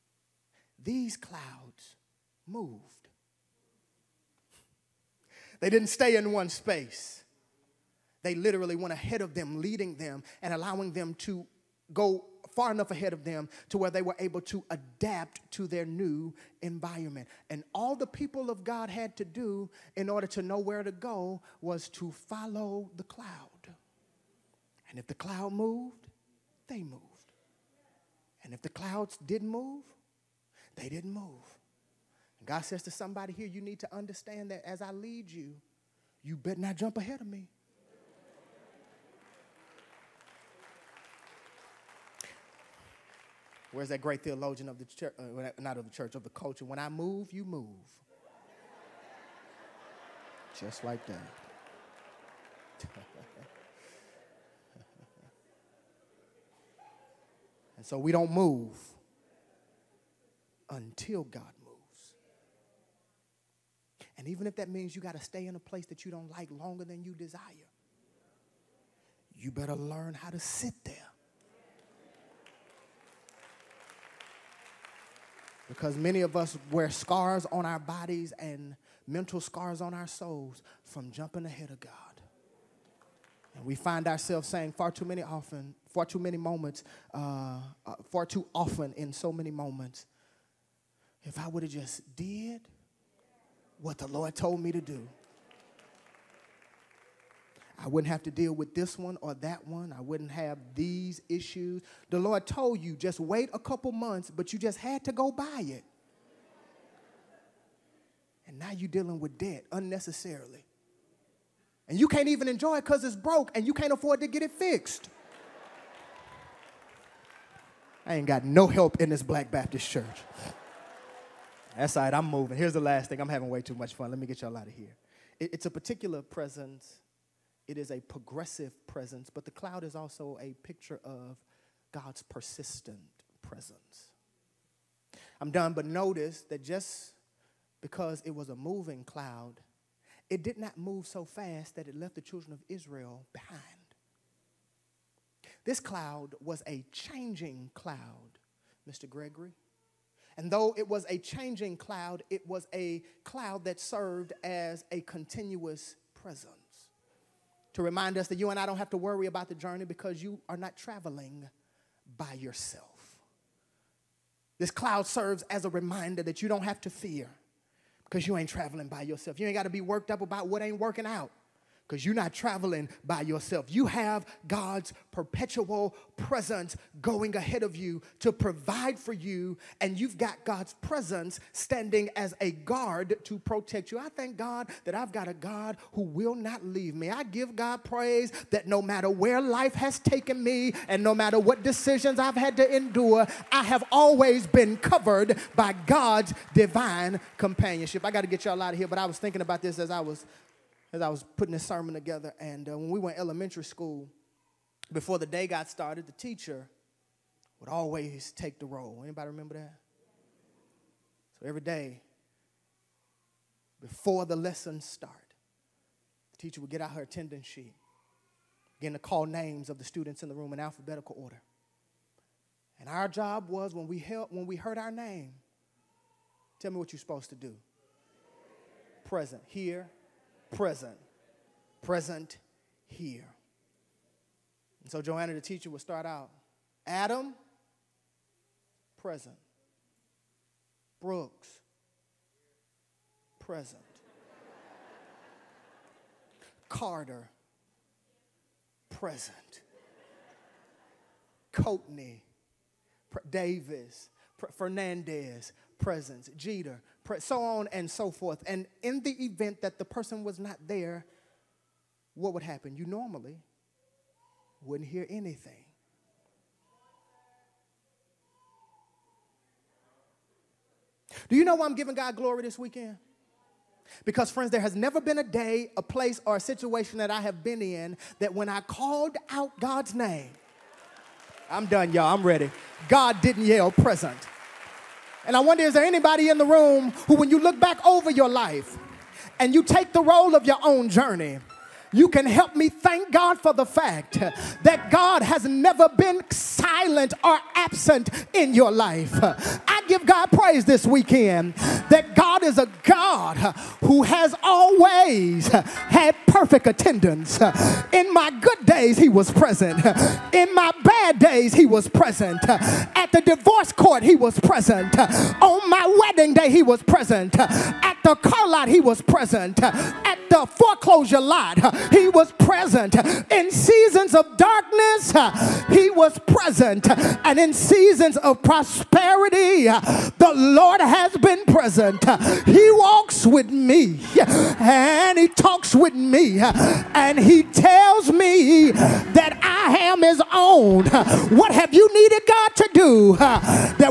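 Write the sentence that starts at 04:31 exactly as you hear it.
Do you know why I'm giving God glory this weekend?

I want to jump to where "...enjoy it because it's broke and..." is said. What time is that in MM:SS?
01:52.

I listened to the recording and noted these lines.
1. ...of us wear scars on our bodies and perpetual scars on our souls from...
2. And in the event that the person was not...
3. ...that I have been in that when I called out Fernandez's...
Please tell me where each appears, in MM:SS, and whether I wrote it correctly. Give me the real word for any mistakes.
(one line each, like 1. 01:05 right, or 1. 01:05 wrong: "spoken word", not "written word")
1. 01:16 wrong: "mental", not "perpetual"
2. 04:18 right
3. 04:36 wrong: "God", not "Fernandez".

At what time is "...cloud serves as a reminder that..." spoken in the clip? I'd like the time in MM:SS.
02:44.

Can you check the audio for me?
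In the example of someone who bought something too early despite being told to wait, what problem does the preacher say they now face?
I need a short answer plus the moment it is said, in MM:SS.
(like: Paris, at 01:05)
Debt, at 01:49.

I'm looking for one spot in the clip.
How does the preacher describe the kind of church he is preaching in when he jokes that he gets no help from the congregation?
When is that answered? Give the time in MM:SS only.
01:59.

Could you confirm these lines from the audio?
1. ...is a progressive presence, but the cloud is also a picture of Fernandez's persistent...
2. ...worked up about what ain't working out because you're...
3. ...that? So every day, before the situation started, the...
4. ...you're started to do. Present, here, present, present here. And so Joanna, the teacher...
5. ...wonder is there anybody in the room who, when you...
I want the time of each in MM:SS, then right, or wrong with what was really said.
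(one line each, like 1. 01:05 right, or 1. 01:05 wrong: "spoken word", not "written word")
1. 02:07 wrong: "God", not "Fernandez"
2. 02:49 right
3. 03:29 wrong: "lesson", not "situation"
4. 03:46 wrong: "supposed", not "started"
5. 04:45 right.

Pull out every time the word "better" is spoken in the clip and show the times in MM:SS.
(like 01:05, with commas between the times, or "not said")
00:36, 01:09.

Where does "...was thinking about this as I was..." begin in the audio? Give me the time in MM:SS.
03:19.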